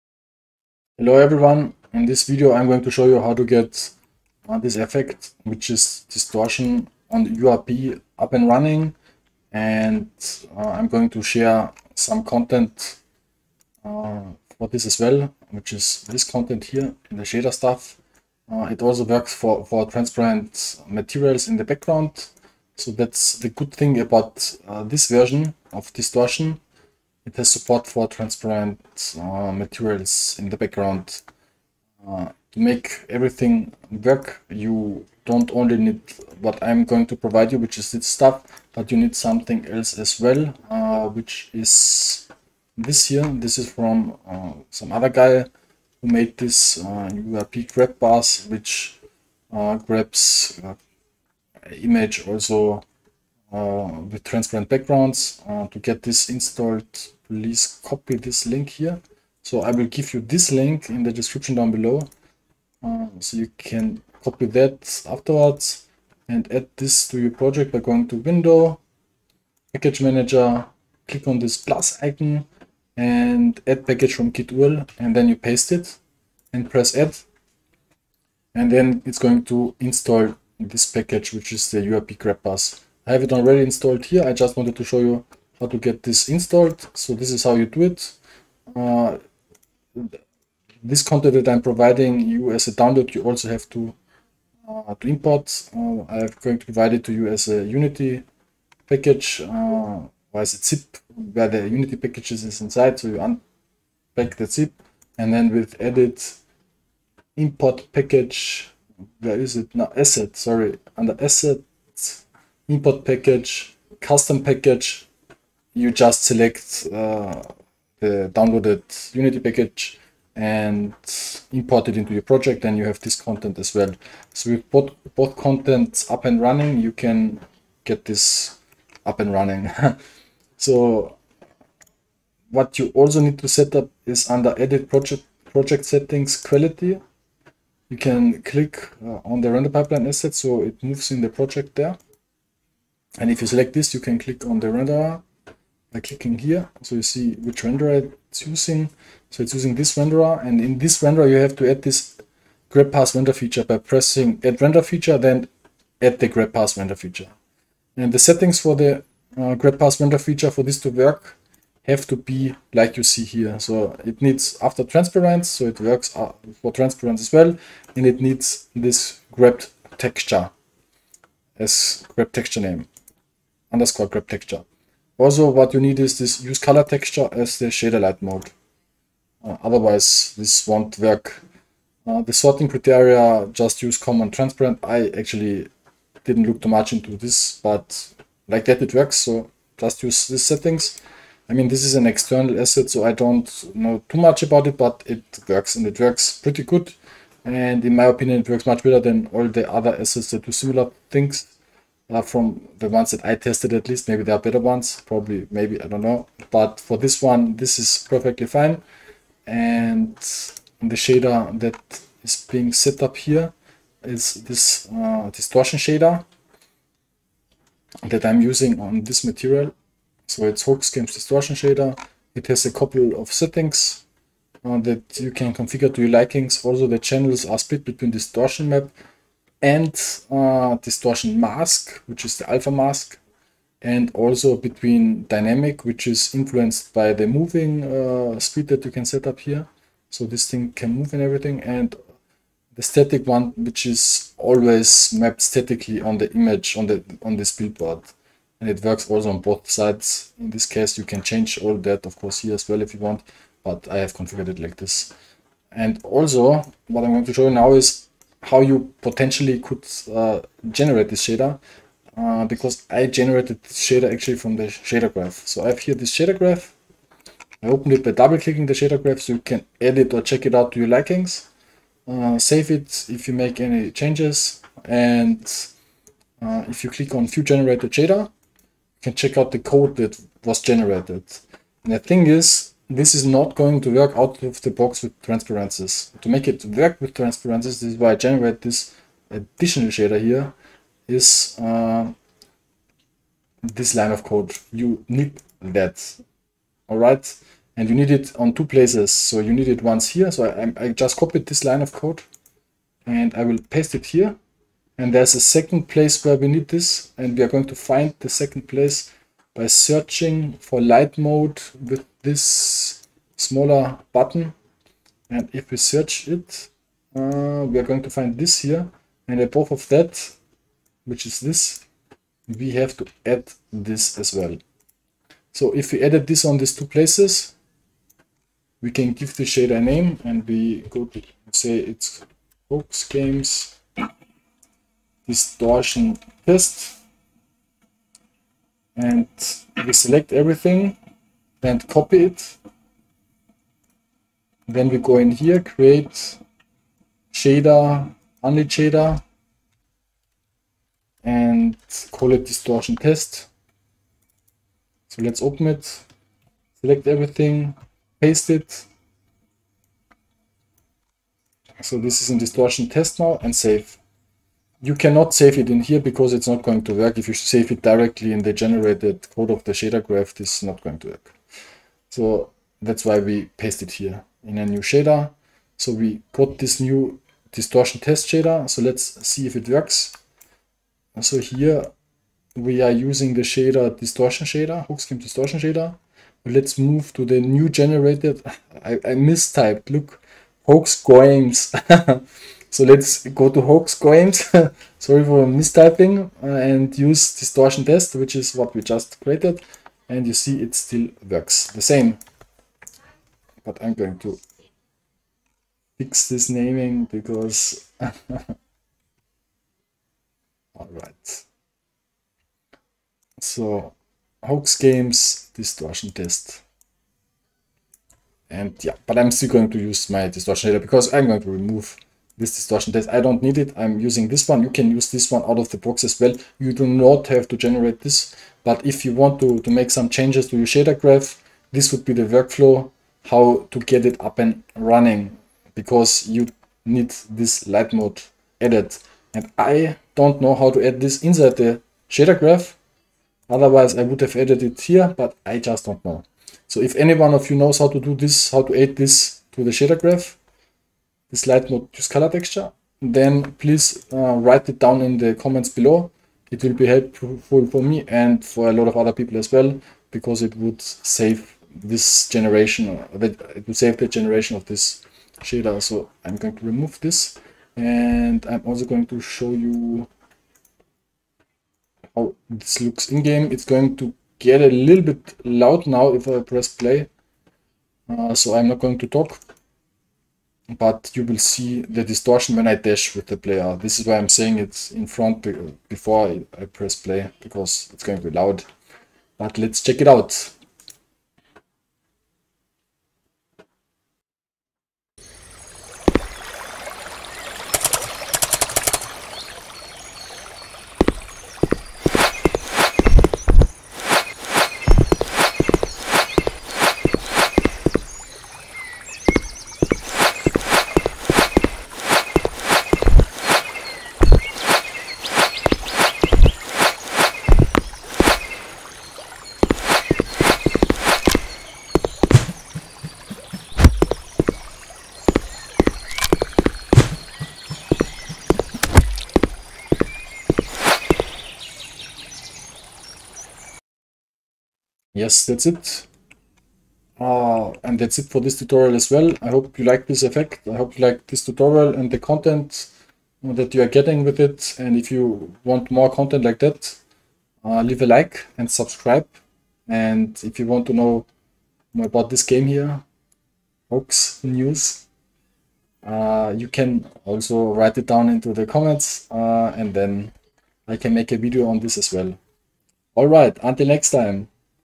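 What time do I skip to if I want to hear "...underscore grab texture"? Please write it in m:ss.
2:53.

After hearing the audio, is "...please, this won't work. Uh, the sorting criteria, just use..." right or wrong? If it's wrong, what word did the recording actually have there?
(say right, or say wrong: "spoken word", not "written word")
wrong: "otherwise", not "please".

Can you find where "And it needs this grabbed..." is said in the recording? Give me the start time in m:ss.
2:47.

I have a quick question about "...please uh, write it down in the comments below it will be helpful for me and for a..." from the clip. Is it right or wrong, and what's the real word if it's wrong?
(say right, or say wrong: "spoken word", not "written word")
right.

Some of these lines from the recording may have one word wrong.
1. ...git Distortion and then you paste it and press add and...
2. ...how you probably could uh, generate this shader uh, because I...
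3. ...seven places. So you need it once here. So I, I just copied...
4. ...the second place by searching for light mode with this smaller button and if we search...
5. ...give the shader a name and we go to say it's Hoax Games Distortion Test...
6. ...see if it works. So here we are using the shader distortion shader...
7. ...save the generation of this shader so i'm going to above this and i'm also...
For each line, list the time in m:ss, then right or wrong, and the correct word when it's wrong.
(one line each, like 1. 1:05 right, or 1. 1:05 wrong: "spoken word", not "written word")
1. 1:14 wrong: "URL", not "Distortion"
2. 4:18 wrong: "potentially", not "probably"
3. 4:58 wrong: "two", not "seven"
4. 5:08 right
5. 5:29 right
6. 6:19 right
7. 7:43 wrong: "remove", not "above".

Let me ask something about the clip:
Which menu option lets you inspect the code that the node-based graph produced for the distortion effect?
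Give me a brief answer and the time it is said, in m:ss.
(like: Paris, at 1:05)
view generated shader, at 4:37.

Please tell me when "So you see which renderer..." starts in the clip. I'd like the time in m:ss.
2:26.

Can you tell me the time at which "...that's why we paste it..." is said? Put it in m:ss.
6:12.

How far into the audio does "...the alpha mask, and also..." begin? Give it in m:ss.
3:52.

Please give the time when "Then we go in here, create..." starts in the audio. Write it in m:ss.
5:44.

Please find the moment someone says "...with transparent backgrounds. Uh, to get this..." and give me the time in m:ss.
0:54.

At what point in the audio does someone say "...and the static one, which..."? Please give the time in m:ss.
4:01.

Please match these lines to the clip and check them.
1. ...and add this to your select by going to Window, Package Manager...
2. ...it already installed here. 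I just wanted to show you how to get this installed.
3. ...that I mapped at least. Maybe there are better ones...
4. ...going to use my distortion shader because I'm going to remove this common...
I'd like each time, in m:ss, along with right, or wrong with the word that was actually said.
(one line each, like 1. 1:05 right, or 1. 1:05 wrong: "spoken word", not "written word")
1. 1:06 wrong: "project", not "select"
2. 1:23 right
3. 3:23 wrong: "tested", not "mapped"
4. 6:59 wrong: "distortion", not "common".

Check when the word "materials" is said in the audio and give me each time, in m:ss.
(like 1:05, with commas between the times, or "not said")
0:20, 0:29, 3:39.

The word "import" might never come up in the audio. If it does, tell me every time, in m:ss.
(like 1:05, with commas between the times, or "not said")
1:35, 1:47, 1:52, 2:01.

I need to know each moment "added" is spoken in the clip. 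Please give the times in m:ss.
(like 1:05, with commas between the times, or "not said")
5:26, 7:18, 7:24.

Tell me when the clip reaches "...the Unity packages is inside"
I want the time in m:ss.
1:41.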